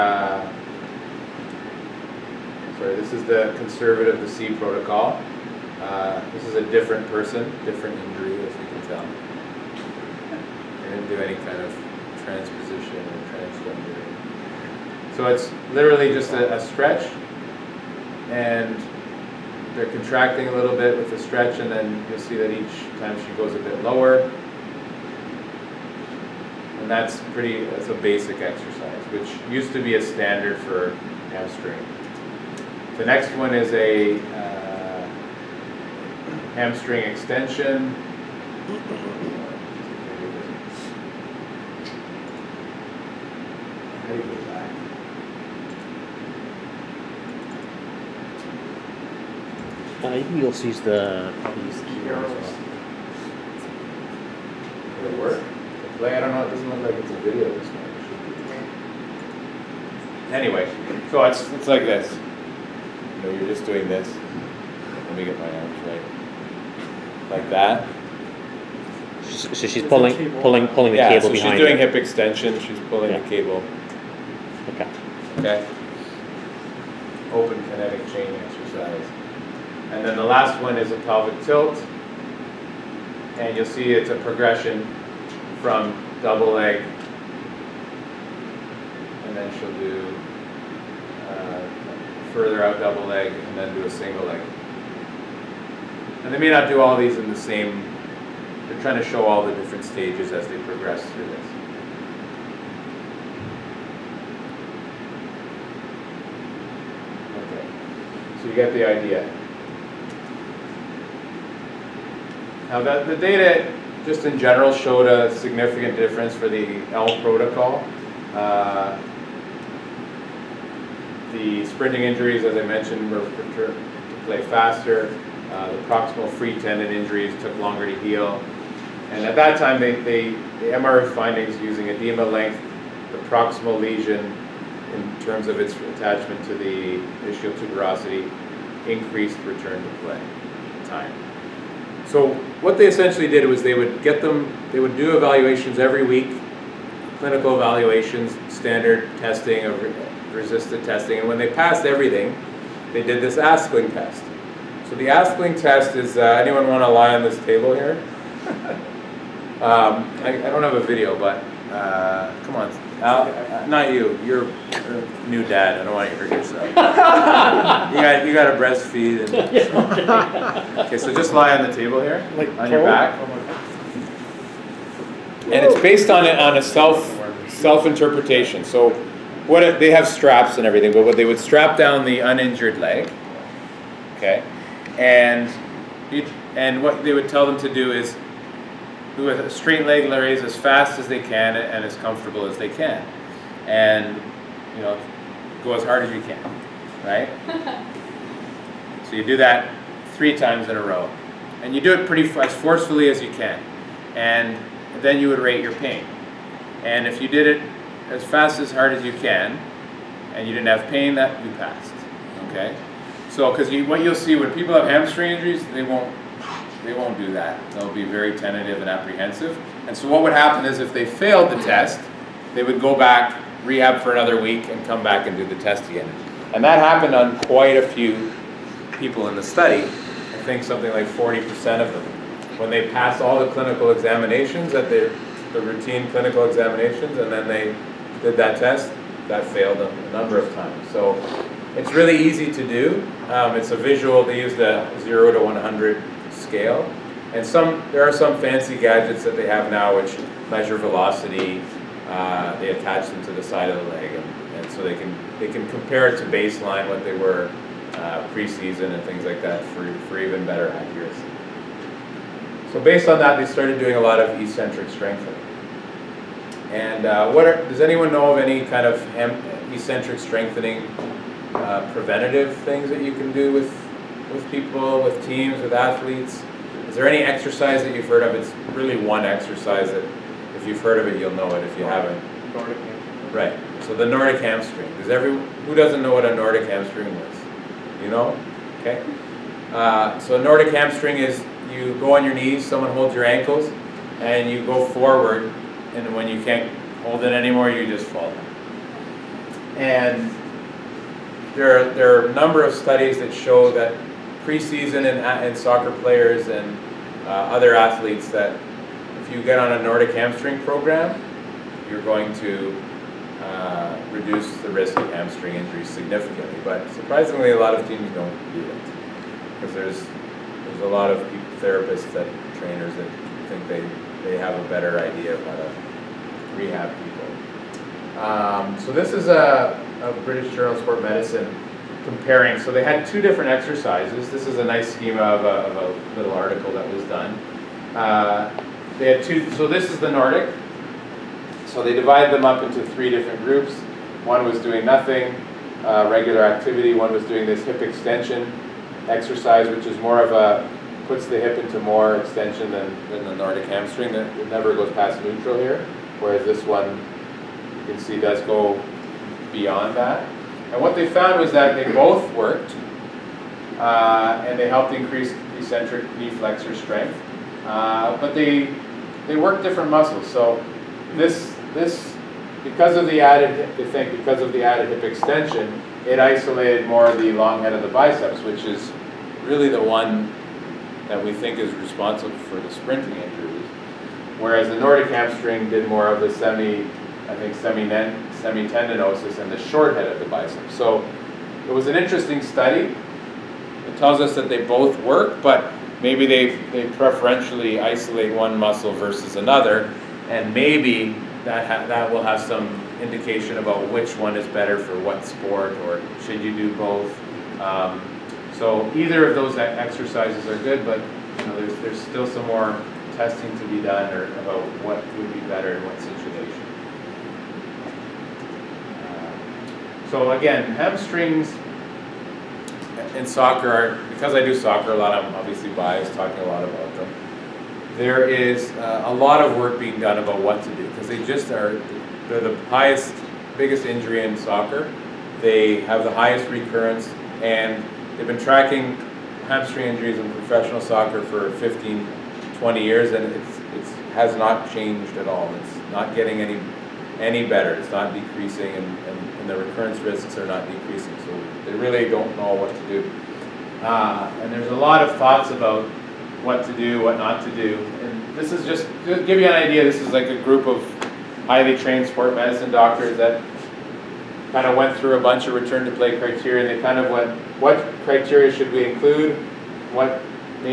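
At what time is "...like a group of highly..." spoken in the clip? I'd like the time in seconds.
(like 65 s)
460 s.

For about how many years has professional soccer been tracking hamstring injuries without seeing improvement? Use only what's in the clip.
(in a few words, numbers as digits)
15 to 20 years.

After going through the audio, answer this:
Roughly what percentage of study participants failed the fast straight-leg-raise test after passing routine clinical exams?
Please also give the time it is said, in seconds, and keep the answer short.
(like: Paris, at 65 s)
40%, at 231 s.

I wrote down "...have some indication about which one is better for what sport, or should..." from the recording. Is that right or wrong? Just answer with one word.
right.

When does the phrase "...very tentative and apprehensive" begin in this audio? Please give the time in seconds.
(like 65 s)
218 s.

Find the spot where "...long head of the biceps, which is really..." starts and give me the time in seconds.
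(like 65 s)
377 s.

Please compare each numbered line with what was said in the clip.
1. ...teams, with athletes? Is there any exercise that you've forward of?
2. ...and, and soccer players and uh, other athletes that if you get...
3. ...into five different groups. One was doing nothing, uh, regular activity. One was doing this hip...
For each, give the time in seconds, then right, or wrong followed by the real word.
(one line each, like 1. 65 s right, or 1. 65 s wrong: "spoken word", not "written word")
1. 275 s wrong: "heard", not "forward"
2. 305 s right
3. 342 s wrong: "three", not "five".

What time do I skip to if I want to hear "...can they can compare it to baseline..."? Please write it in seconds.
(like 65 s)
254 s.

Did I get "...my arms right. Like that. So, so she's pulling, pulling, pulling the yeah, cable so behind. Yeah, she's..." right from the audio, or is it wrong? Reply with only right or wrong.
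right.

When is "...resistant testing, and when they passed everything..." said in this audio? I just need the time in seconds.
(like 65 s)
150 s.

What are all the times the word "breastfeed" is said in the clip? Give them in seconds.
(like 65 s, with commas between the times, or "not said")
168 s.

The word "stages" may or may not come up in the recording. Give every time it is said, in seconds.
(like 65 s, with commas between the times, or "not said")
99 s.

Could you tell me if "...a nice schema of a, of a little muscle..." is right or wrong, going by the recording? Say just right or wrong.
wrong.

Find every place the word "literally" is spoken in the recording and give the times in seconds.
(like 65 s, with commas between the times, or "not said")
15 s.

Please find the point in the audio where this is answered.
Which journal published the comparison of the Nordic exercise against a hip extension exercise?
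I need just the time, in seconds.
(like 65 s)
330 s.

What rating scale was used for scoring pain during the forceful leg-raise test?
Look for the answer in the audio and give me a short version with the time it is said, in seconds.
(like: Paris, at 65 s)
0 to 100, at 245 s.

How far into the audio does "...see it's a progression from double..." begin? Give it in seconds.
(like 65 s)
83 s.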